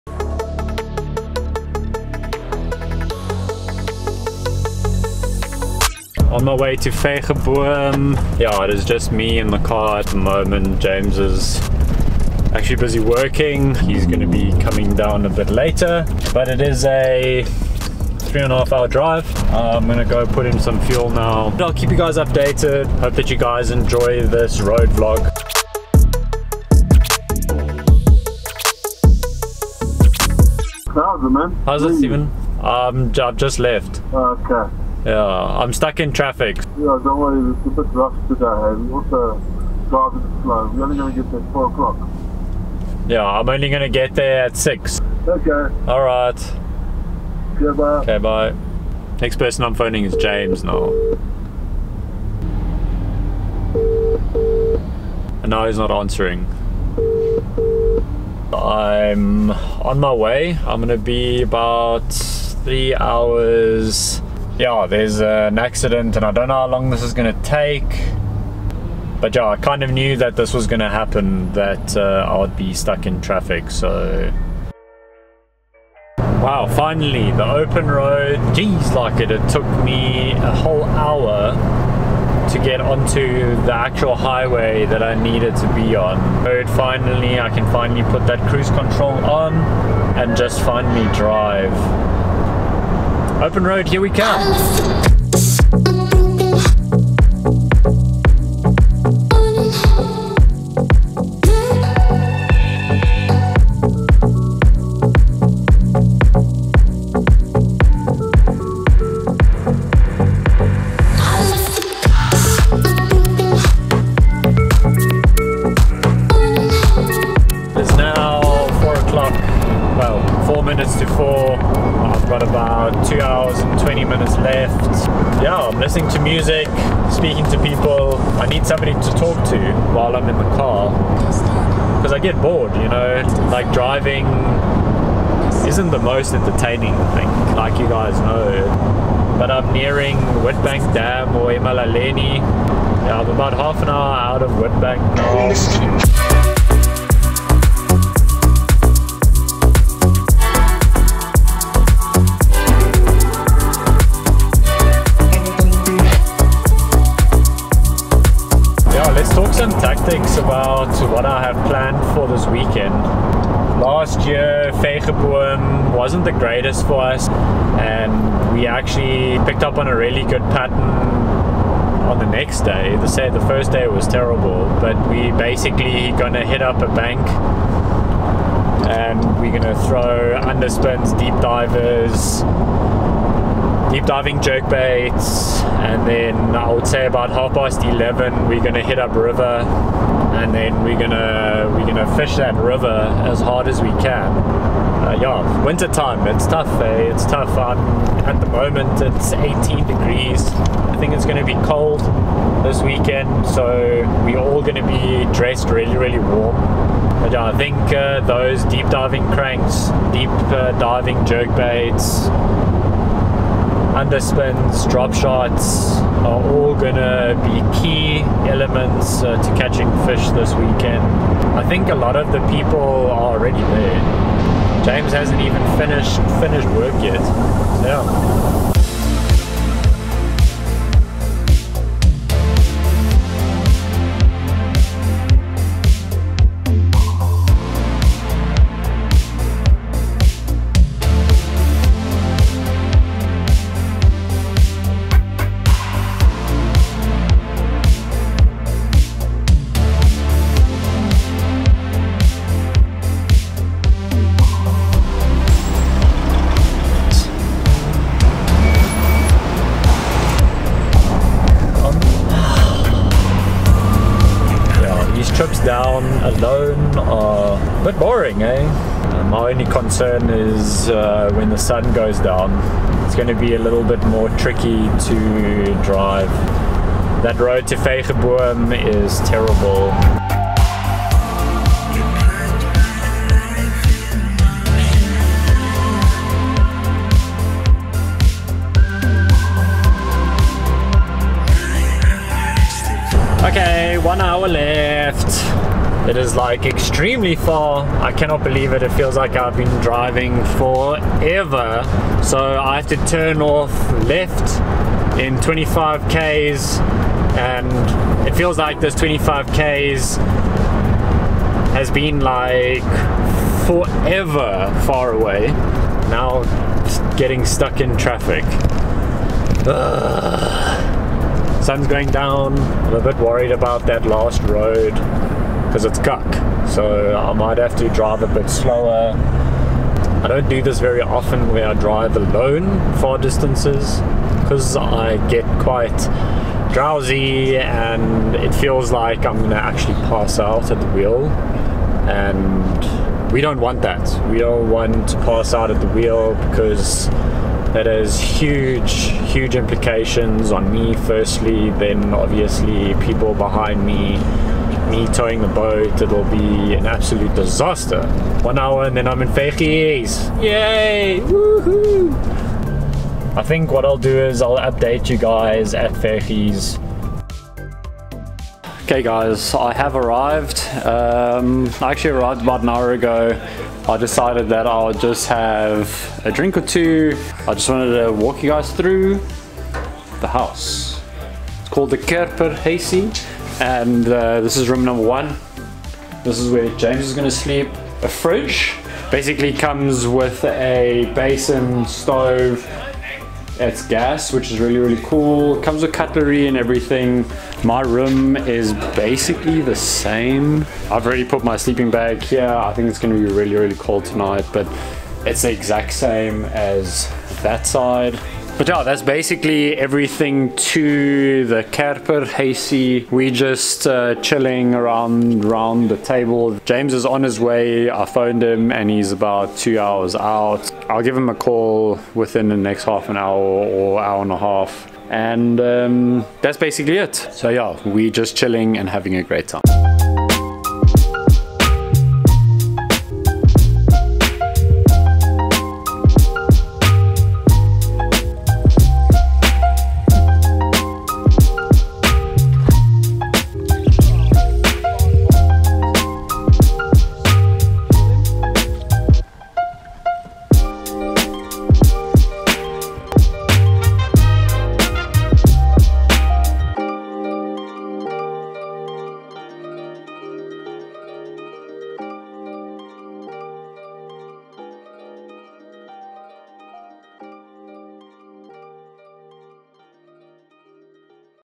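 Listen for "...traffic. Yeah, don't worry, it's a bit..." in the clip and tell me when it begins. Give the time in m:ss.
0:36.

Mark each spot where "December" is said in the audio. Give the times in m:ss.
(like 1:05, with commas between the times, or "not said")
not said.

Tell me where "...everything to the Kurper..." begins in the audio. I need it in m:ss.
6:49.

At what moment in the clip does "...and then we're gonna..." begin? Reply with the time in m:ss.
3:10.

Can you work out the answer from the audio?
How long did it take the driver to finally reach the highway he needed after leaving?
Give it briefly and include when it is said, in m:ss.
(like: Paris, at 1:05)
A whole hour, at 1:20.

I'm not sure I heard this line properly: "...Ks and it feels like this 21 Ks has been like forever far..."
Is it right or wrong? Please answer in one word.
wrong.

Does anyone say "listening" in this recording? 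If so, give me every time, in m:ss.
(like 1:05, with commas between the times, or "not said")
2:05.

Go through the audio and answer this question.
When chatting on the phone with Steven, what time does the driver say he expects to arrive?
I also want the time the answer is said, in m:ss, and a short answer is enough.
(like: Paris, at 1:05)
6, at 0:44.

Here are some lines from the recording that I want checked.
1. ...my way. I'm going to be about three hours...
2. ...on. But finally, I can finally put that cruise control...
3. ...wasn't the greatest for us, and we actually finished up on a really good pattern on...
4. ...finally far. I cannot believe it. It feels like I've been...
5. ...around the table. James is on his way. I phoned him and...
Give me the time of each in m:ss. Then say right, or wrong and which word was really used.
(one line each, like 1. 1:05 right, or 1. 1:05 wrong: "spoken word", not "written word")
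1. 0:59 right
2. 1:25 right
3. 2:45 wrong: "picked", not "finished"
4. 4:56 wrong: "extremely", not "finally"
5. 6:55 right.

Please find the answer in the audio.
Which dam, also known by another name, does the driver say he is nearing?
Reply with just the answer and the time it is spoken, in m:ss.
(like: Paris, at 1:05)
Witbank Dam, at 2:20.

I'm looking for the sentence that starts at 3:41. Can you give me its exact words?
I think a lot of the people are already there.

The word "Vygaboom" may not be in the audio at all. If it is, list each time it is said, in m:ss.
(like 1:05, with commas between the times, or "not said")
0:06, 2:44, 4:37.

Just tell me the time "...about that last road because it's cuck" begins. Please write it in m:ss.
5:23.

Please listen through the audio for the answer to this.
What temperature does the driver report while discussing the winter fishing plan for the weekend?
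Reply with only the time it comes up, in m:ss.
3:19.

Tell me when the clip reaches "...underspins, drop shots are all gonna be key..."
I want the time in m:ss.
3:34.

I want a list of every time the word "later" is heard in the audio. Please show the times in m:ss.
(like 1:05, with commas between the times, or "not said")
0:15.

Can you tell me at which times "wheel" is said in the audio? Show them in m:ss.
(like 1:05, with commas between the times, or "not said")
5:40, 5:45.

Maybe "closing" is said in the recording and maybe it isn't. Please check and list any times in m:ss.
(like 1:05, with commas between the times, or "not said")
not said.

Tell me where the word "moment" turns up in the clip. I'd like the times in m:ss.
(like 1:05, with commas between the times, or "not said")
0:10, 3:18.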